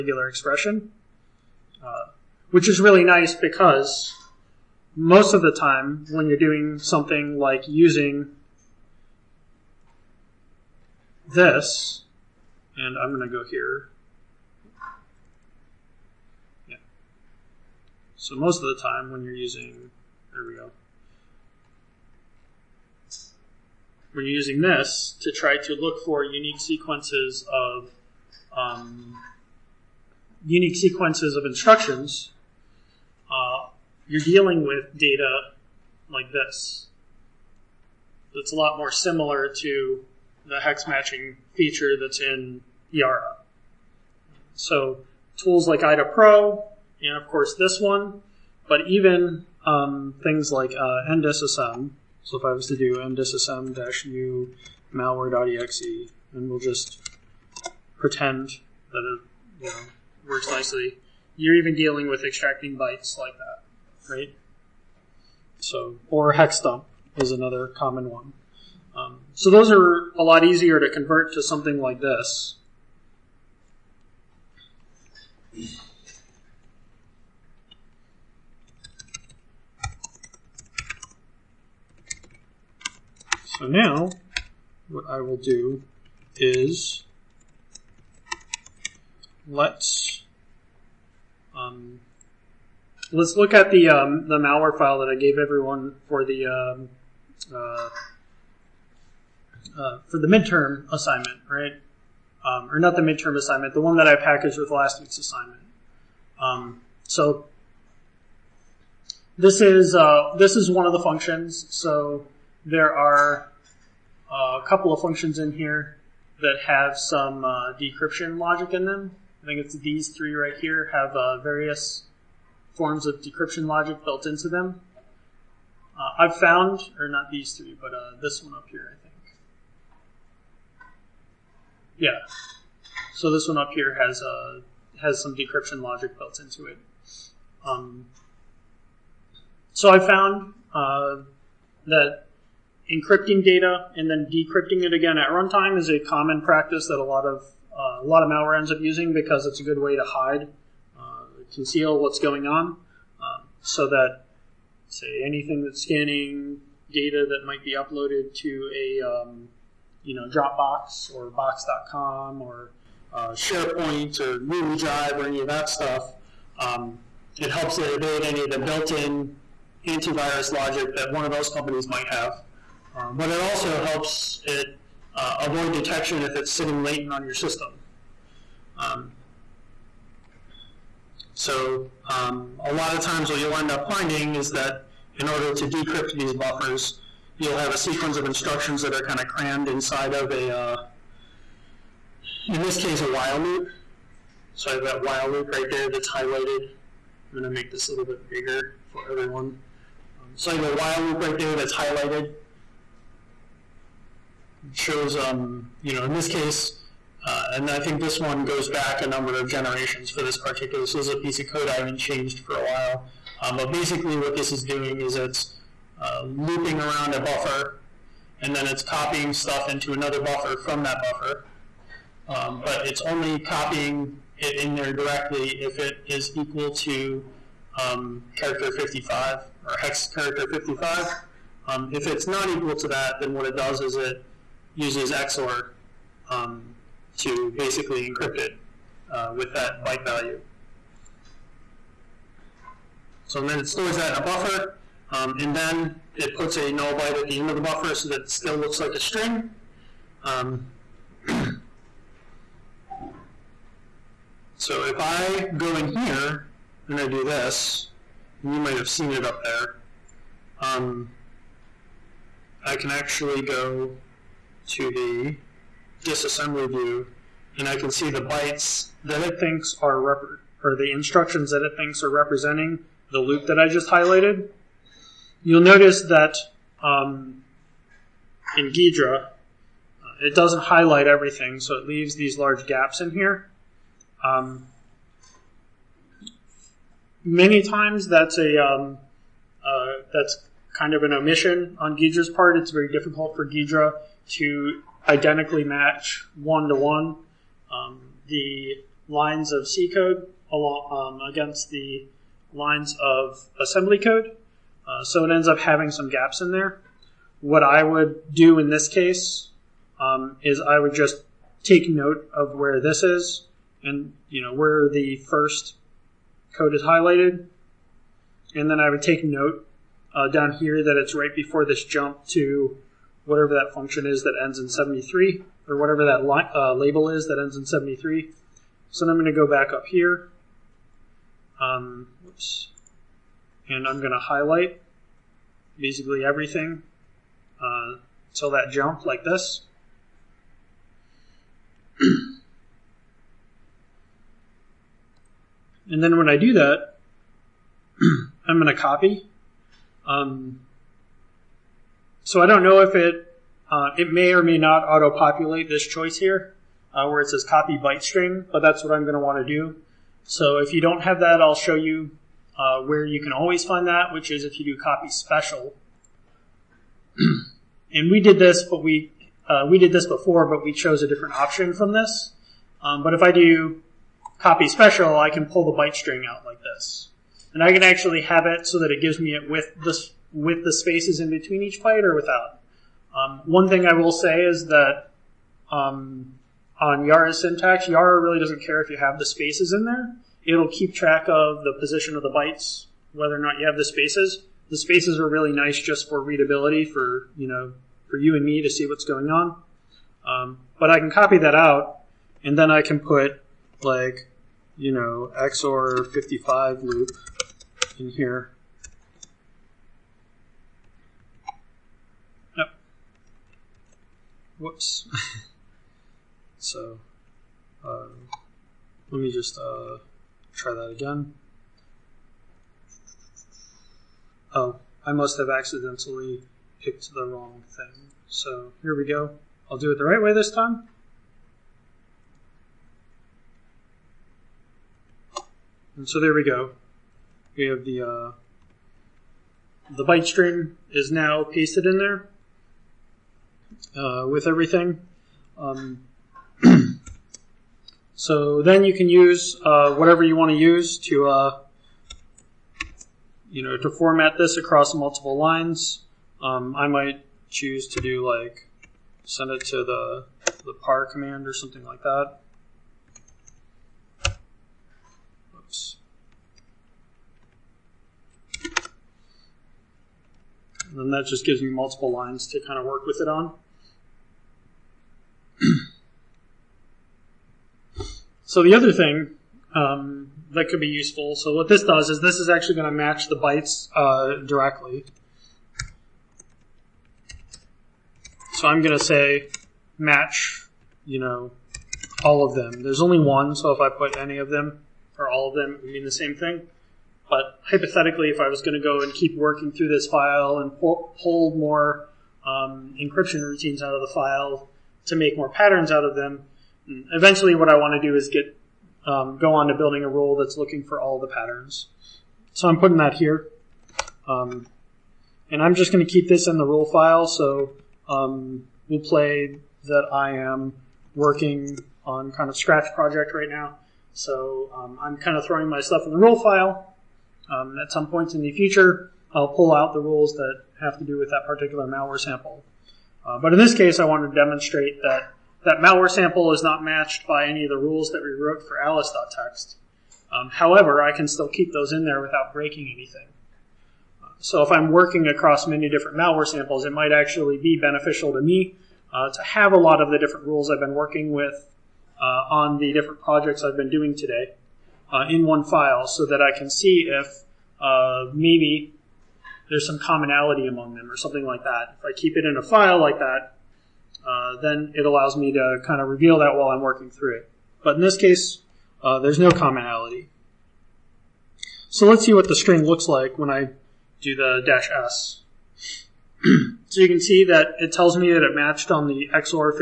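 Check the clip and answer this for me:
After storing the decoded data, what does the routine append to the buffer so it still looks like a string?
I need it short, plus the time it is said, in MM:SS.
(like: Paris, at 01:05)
null byte, at 04:06.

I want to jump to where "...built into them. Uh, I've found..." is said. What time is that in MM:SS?
02:04.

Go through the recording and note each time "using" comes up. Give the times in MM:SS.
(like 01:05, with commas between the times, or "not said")
00:07, 00:19, 00:24, 02:28.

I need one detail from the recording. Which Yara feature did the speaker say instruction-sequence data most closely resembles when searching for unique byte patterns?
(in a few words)
hex matching.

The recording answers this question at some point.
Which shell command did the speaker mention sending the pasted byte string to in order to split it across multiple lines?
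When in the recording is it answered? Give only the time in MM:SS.
07:40.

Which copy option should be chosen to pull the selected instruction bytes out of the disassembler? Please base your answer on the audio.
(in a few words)
copy byte string.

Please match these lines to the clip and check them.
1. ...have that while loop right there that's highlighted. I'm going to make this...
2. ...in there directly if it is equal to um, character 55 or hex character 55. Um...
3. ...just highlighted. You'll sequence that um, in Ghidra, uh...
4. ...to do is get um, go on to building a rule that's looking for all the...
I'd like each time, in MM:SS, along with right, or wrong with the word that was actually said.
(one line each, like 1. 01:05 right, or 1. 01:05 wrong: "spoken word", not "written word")
1. 03:14 right
2. 03:44 right
3. 04:33 wrong: "notice", not "sequence"
4. 08:28 right.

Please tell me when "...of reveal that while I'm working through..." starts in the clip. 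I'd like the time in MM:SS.
09:26.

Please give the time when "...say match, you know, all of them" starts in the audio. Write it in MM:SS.
08:09.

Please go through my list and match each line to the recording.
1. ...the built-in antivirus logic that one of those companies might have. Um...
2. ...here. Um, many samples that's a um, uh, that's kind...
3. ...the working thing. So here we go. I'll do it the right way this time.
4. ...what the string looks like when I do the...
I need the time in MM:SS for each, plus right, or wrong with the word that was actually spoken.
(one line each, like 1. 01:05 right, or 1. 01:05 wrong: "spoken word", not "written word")
1. 02:48 right
2. 04:43 wrong: "times", not "samples"
3. 07:07 wrong: "wrong", not "working"
4. 09:32 right.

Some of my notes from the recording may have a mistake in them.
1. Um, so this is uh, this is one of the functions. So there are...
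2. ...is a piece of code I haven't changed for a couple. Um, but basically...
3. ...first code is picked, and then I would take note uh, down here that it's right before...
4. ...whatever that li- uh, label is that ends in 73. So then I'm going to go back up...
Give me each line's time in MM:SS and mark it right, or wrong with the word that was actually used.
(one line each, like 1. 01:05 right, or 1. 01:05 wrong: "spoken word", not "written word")
1. 01:46 right
2. 03:30 wrong: "while", not "couple"
3. 05:15 wrong: "highlighted", not "picked"
4. 05:25 right.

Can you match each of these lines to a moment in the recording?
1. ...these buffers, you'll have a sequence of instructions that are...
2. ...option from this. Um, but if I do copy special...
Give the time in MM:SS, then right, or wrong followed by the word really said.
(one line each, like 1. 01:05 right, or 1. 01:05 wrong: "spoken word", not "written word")
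1. 03:06 right
2. 06:11 right.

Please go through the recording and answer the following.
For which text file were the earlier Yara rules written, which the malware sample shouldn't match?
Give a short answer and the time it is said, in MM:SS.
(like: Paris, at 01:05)
alice.txt, at 08:58.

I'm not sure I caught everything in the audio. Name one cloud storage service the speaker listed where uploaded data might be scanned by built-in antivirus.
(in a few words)
Dropbox.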